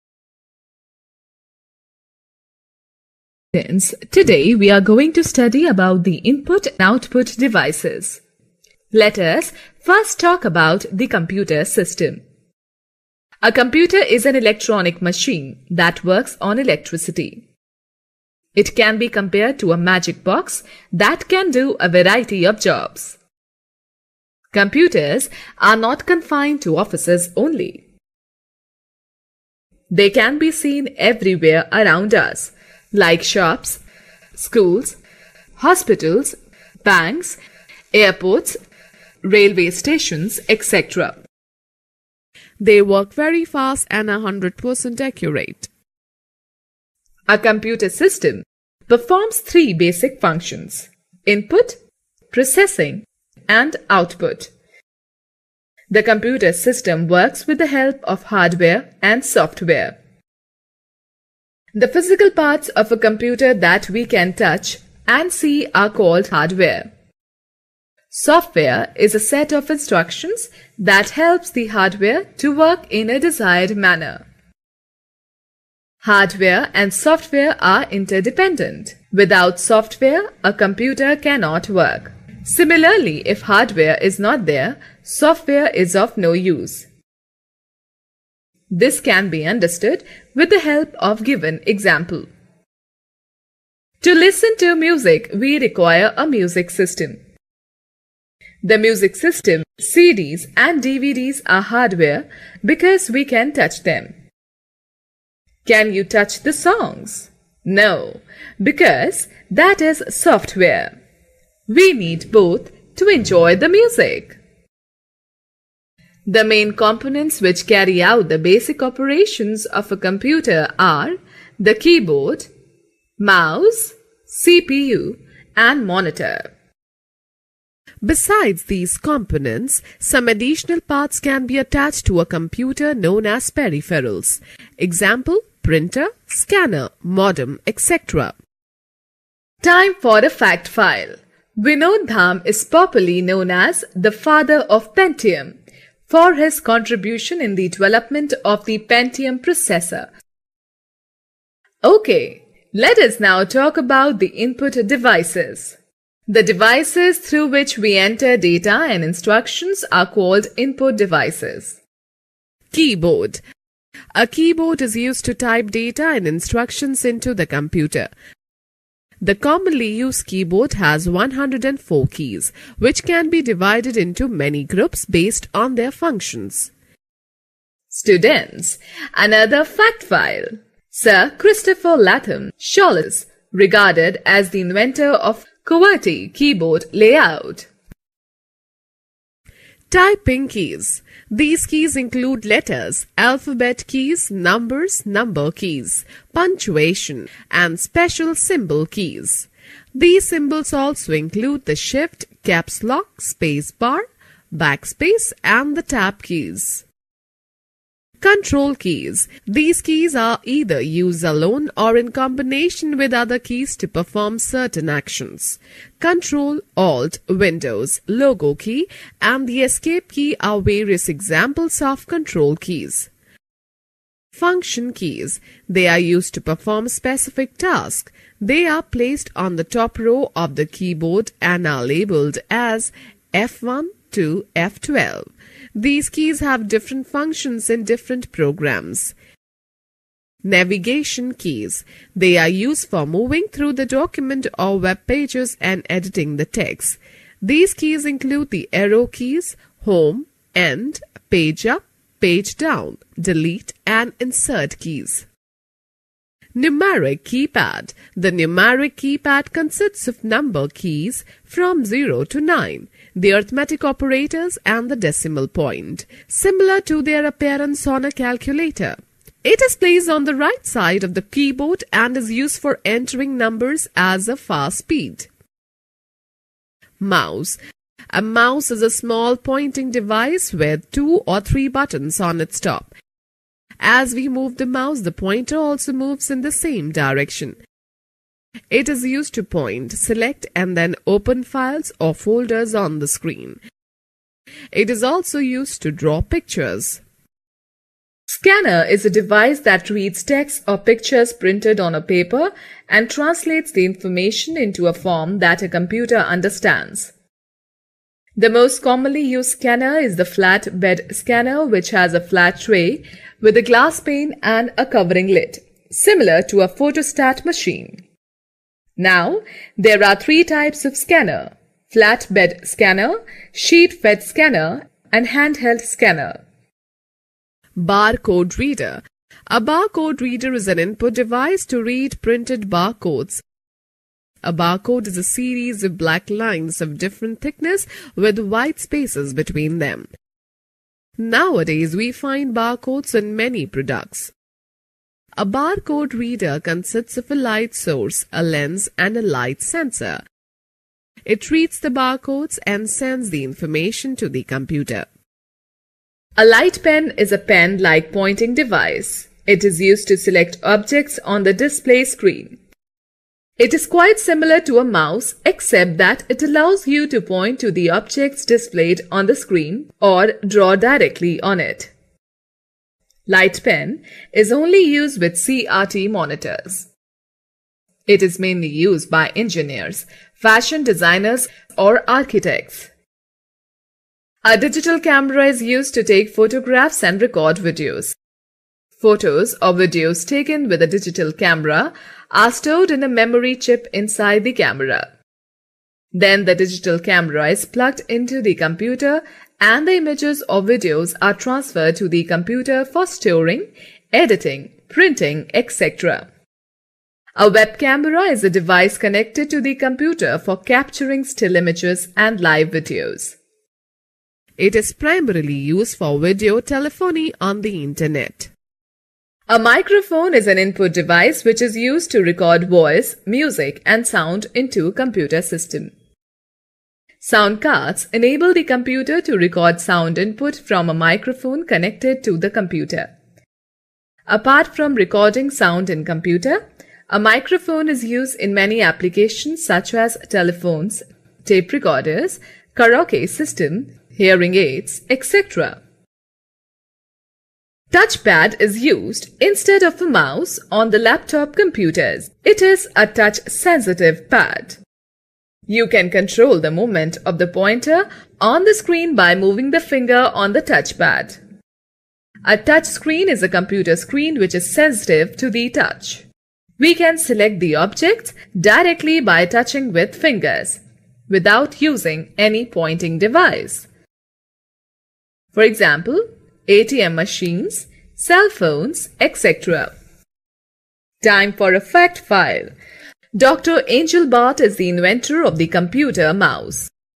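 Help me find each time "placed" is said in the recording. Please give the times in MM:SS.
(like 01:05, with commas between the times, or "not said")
03:48, 04:29.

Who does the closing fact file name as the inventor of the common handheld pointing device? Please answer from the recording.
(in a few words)
Dr. Engelbart.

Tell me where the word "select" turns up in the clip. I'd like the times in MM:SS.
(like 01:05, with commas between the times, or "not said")
04:49, 06:00, 07:47.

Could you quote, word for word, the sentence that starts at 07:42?
A touch screen is a computer screen which is sensitive to the touch.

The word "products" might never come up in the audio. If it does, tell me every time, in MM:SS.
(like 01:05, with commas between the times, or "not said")
05:43.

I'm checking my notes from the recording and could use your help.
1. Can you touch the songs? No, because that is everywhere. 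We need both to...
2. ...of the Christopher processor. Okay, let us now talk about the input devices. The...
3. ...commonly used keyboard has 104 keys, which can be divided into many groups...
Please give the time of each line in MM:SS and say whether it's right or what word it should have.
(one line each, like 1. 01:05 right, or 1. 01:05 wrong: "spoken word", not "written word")
1. 01:45 wrong: "software", not "everywhere"
2. 02:28 wrong: "Pentium", not "Christopher"
3. 02:49 right.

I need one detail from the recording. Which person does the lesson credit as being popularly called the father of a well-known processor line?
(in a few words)
Vinod Dham.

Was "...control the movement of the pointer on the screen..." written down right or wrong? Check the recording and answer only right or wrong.
right.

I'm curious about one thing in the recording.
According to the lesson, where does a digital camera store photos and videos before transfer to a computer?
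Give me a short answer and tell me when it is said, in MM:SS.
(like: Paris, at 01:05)
Memory chip, at 06:33.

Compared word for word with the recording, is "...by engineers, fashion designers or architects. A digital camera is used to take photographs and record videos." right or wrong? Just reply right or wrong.
right.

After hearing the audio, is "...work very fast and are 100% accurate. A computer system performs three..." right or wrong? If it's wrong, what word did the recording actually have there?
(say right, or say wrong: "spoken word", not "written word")
right.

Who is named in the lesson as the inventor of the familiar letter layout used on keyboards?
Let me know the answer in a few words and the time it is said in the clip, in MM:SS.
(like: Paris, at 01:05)
Sir Christopher Latham Scholes, at 03:00.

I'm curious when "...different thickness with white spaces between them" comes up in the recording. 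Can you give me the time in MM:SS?
05:36.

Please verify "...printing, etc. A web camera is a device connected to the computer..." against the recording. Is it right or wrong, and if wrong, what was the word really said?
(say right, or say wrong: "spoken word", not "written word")
right.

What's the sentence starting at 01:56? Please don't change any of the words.
The main components which carry out the basic operations of a computer are the keyboard, mouse, CPU, and monitor.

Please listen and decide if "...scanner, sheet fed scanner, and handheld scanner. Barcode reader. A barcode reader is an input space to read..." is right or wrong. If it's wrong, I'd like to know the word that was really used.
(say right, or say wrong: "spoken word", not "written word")
wrong: "device", not "space".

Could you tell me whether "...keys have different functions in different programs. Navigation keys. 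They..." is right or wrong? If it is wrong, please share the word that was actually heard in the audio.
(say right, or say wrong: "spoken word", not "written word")
right.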